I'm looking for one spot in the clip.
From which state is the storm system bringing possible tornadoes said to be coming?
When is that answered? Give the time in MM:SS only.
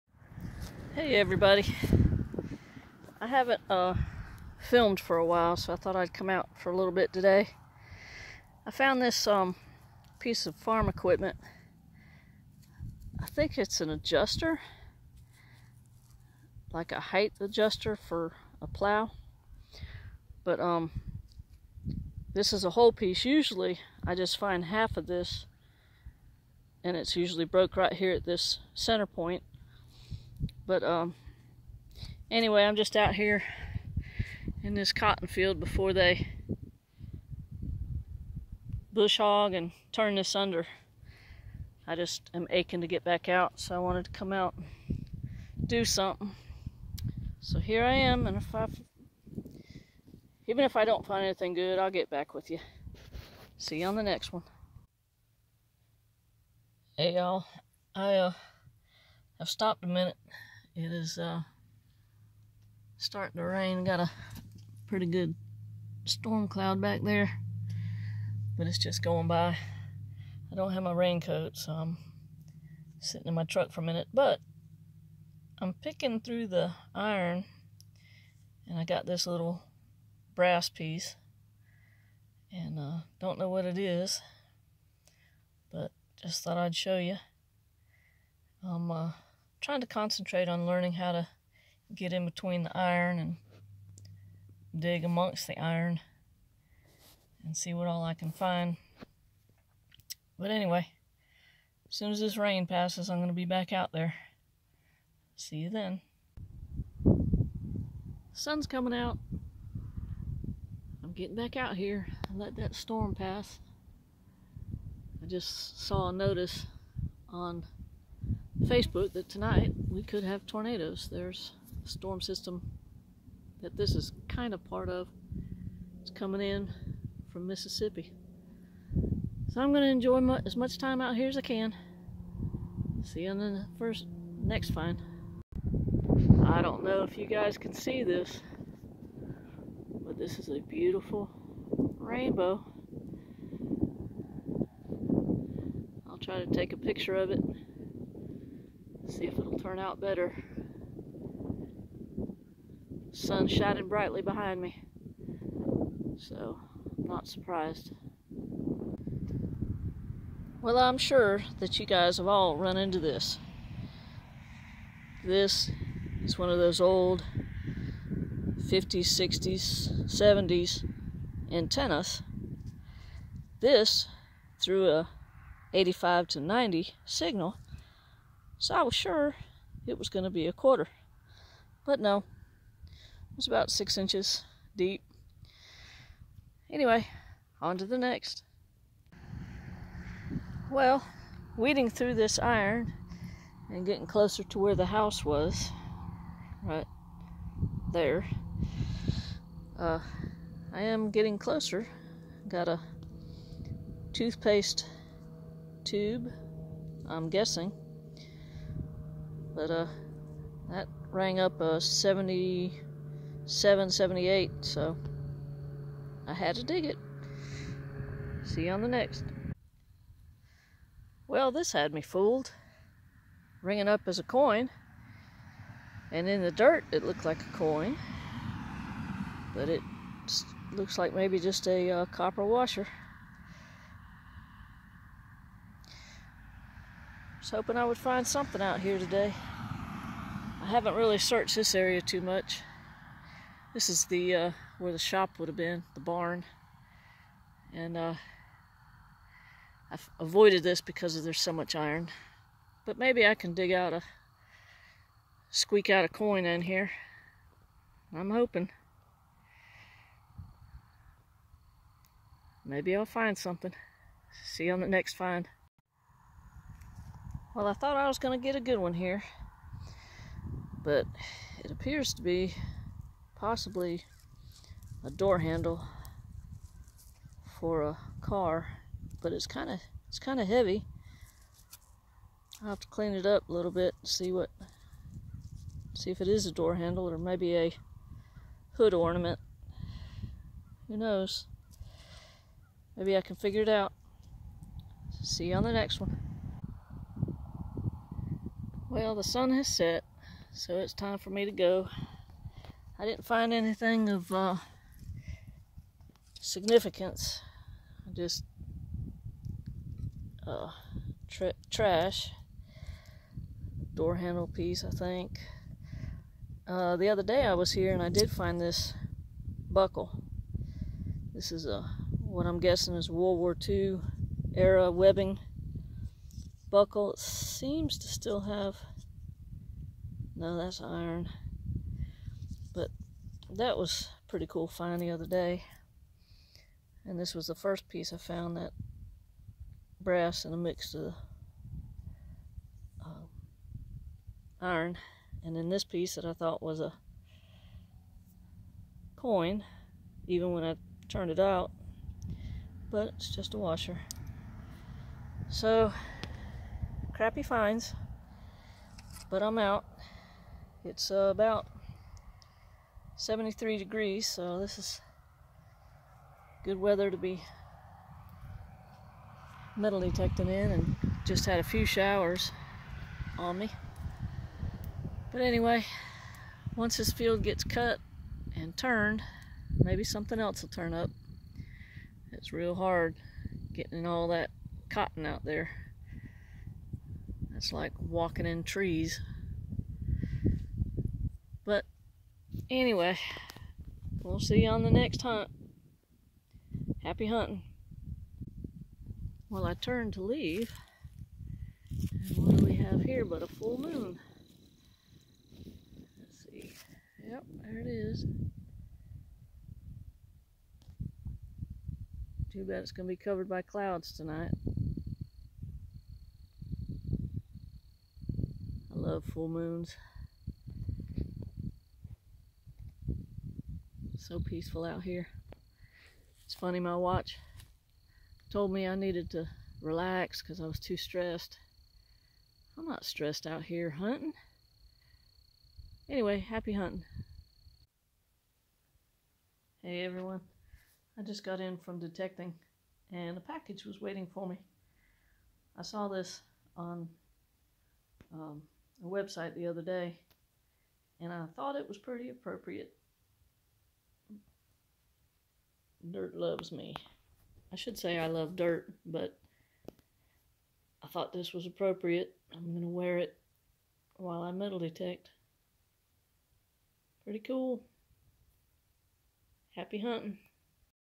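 02:07.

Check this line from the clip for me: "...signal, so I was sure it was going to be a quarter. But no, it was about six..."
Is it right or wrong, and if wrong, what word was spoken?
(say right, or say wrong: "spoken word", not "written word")
right.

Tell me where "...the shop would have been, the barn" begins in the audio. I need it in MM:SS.
04:04.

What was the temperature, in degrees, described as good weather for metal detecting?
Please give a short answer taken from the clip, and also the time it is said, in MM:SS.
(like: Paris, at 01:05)
73, at 06:03.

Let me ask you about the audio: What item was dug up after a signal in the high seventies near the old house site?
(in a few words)
toothpaste tube.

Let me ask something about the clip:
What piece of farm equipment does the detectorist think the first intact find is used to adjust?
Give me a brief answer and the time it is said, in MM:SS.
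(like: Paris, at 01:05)
a plow, at 00:18.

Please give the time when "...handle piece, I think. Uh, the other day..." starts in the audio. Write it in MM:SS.
05:14.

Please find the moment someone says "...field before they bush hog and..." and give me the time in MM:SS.
00:35.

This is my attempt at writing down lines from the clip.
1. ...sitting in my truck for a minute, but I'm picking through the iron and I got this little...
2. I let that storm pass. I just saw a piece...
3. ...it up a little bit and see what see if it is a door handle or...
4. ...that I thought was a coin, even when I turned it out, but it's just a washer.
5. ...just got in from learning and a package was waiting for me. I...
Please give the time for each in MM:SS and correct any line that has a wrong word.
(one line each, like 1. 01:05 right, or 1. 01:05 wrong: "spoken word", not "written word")
1. 01:13 right
2. 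01:52 wrong: "notice", not "piece"
3. 04:43 right
4. 05:46 right
5. 07:21 wrong: "detecting", not "learning".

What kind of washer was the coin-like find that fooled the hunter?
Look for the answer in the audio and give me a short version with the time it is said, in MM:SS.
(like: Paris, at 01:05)
copper, at 03:52.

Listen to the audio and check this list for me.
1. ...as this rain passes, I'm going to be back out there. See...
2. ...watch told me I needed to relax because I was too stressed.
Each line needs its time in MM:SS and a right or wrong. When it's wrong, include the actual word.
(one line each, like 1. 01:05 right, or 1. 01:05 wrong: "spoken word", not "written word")
1. 01:42 right
2. 07:06 right.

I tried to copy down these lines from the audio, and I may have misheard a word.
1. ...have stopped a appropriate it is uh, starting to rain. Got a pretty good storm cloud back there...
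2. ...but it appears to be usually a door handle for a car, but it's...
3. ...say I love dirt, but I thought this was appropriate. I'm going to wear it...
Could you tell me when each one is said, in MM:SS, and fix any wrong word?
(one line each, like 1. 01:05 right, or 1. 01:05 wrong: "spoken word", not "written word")
1. 00:59 wrong: "minute", not "appropriate"
2. 04:30 wrong: "possibly", not "usually"
3. 07:37 right.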